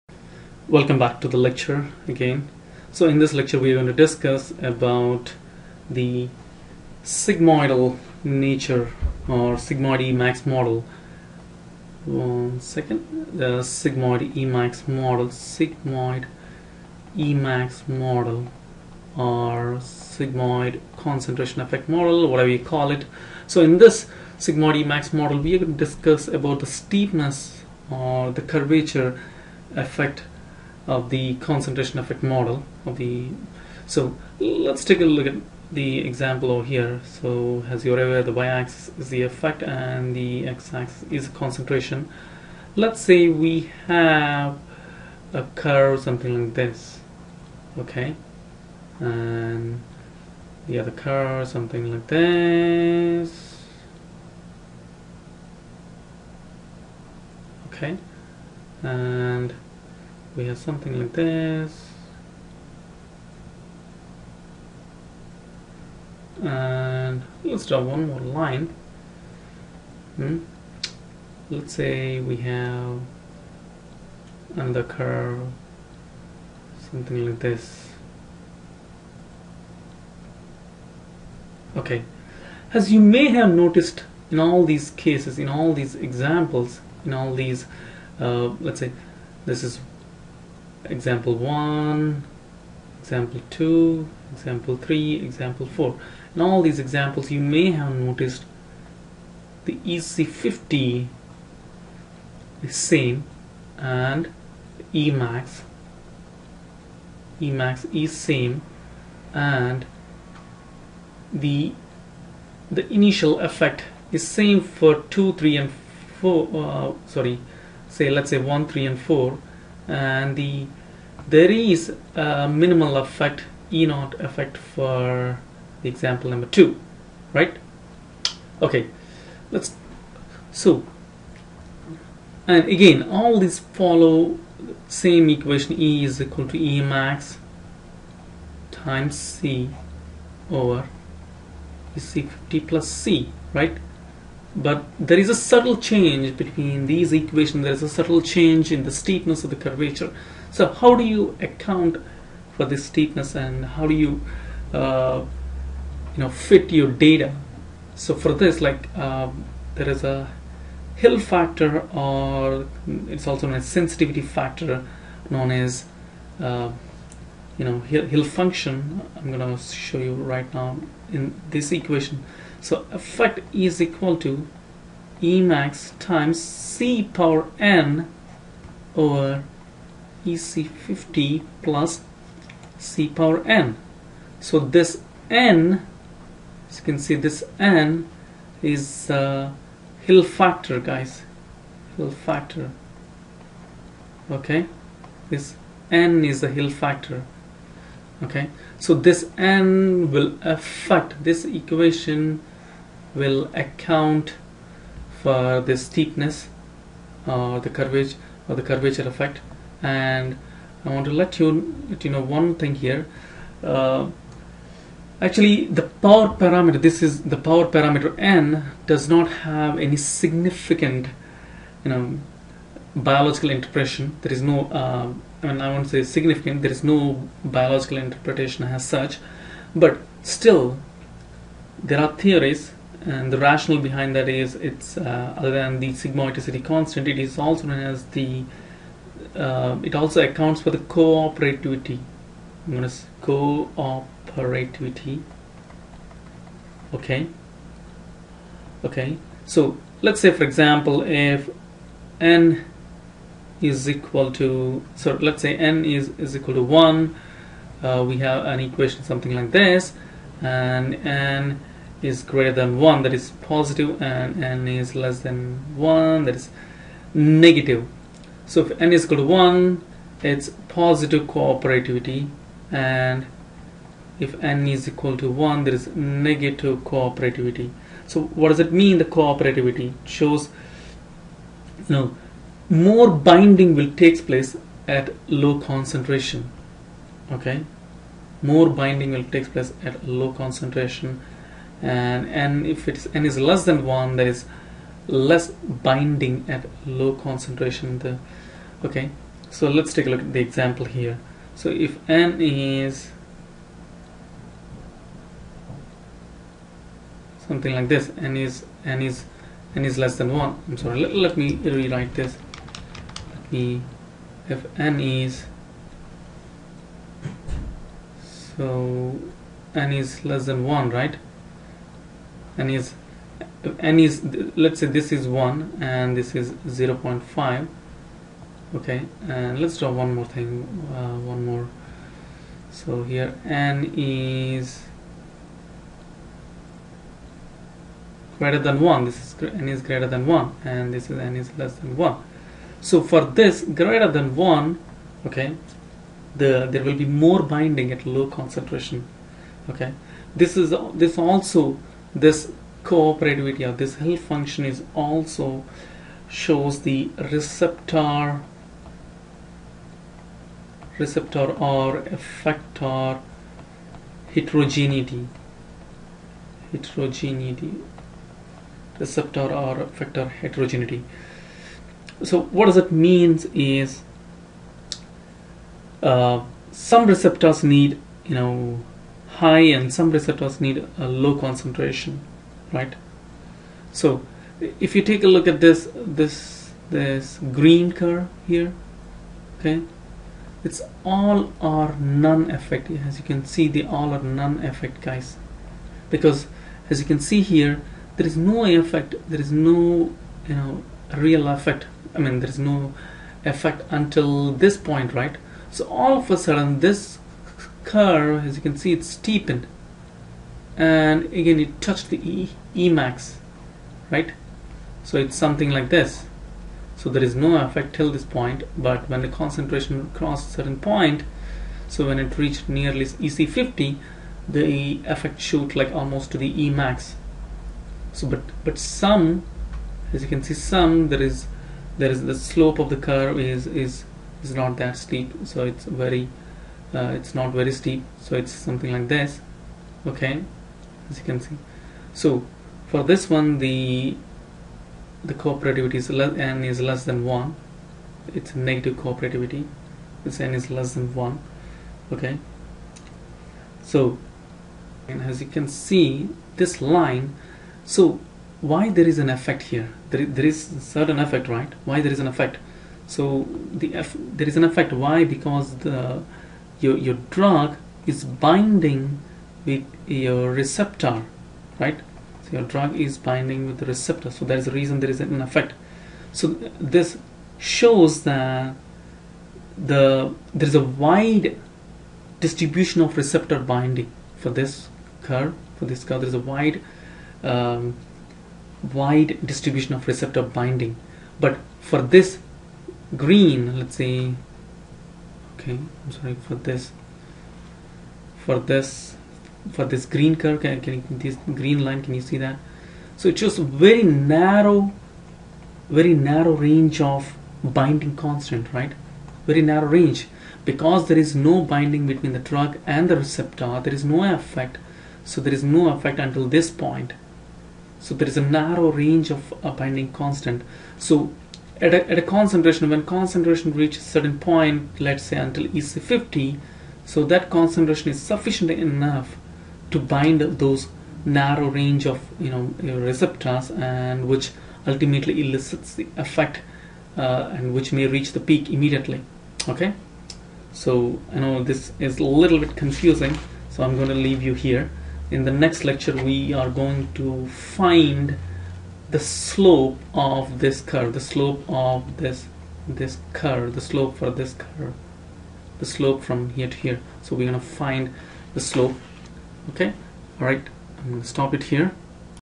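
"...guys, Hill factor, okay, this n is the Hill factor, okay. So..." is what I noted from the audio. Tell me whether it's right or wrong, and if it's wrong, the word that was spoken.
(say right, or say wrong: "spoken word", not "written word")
right.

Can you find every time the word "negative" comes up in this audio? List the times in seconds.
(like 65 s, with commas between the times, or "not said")
267 s, 276 s, 448 s.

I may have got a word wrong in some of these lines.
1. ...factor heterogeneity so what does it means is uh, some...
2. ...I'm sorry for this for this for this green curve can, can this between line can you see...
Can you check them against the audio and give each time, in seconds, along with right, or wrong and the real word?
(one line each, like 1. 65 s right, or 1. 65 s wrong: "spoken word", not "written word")
1. 369 s wrong: "effector", not "factor"
2. 495 s wrong: "green", not "between".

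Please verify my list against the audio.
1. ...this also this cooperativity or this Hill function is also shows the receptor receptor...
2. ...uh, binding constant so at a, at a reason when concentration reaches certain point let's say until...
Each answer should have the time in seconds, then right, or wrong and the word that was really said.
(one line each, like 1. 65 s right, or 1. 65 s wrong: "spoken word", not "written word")
1. 350 s right
2. 519 s wrong: "concentration", not "reason".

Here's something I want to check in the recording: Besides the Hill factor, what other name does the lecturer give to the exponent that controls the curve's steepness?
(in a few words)
Sensitivity factor.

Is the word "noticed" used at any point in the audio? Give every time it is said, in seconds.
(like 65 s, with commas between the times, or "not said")
83 s, 97 s.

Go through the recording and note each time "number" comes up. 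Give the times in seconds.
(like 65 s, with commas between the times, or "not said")
126 s.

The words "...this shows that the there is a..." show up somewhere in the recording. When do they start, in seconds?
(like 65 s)
476 s.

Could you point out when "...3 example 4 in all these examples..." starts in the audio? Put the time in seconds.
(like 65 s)
94 s.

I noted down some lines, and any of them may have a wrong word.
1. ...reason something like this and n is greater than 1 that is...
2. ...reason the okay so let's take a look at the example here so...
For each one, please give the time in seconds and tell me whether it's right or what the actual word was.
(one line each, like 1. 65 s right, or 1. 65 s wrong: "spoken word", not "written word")
1. 258 s wrong: "equation", not "reason"
2. 297 s wrong: "concentration", not "reason".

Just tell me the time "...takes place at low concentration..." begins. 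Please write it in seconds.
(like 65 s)
284 s.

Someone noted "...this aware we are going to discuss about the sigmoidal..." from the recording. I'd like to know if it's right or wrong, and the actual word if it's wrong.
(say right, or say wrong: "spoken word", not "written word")
wrong: "lecture", not "aware".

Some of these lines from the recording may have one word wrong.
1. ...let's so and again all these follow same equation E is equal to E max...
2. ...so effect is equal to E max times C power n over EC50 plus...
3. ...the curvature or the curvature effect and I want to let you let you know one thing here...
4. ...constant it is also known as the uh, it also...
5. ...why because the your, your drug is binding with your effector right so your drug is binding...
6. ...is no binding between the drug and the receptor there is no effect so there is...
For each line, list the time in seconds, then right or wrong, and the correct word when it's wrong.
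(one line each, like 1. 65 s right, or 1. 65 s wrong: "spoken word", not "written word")
1. 129 s right
2. 172 s right
3. 207 s right
4. 236 s right
5. 464 s wrong: "receptor", not "effector"
6. 511 s right.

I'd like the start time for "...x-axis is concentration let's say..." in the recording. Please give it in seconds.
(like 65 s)
40 s.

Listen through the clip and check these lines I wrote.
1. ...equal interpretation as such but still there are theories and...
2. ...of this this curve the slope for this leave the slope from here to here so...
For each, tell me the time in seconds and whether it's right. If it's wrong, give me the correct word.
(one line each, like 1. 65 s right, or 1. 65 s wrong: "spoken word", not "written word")
1. 227 s wrong: "biological", not "equal"
2. 551 s wrong: "curve", not "leave".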